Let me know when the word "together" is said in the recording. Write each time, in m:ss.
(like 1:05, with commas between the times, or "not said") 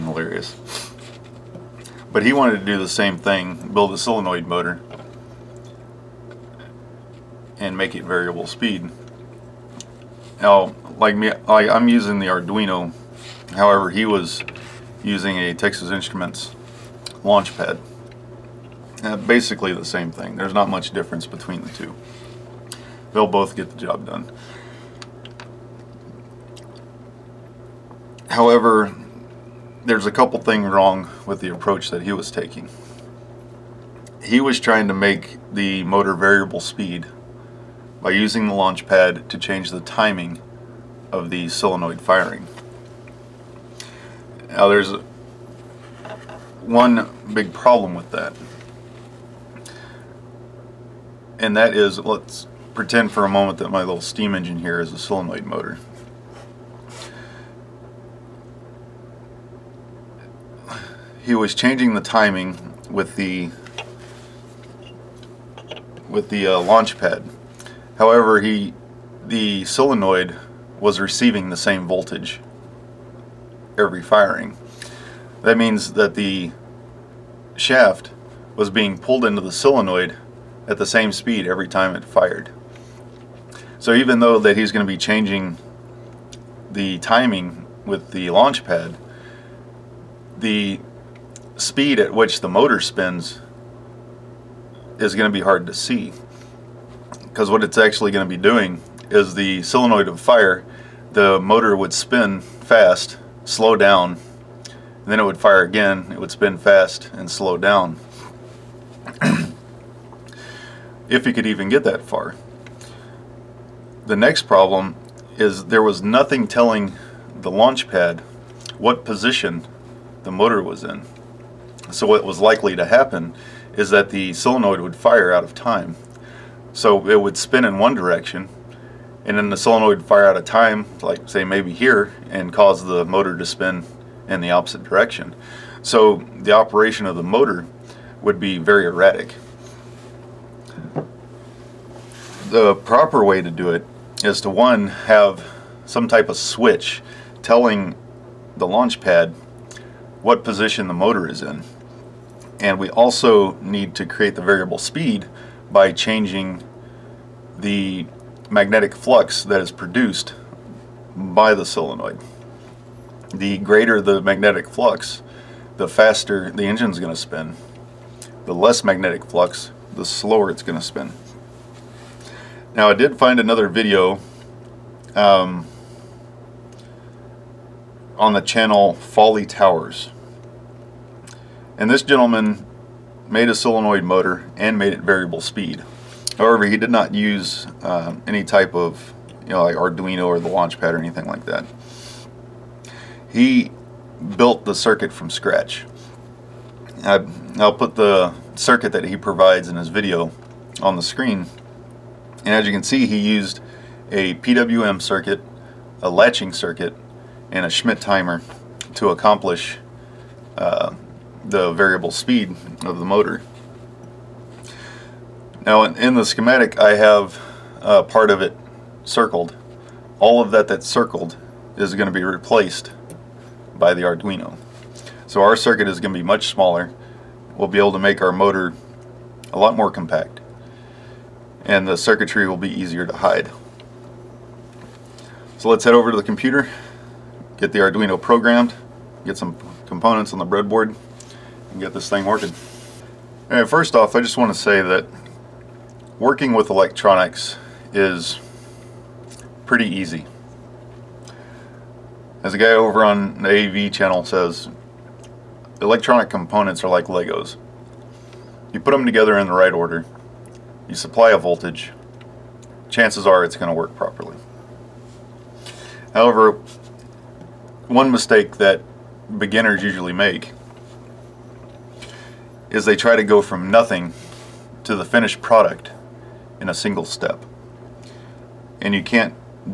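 4:19.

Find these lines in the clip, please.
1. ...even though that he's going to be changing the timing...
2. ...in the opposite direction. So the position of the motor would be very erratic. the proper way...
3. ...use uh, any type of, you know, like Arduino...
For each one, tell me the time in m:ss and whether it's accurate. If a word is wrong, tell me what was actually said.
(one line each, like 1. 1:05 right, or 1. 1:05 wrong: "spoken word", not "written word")
1. 1:23 right
2. 2:14 wrong: "operation", not "position"
3. 3:07 right.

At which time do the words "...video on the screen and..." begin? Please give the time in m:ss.
3:19.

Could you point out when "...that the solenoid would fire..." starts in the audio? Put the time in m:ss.
2:03.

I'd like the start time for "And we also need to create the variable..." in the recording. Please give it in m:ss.
2:32.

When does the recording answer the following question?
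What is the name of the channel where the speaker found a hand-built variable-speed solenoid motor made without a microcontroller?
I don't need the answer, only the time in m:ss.
2:58.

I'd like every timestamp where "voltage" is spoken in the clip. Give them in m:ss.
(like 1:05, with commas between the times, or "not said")
1:11, 4:21.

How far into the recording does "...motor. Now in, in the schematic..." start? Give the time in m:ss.
3:33.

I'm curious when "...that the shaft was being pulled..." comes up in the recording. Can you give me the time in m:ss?
1:15.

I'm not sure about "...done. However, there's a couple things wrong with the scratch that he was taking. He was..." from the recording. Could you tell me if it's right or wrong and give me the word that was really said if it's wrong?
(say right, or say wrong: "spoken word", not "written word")
wrong: "approach", not "scratch".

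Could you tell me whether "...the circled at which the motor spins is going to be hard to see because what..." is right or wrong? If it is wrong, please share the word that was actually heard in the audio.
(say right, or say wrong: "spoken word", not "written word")
wrong: "speed", not "circled".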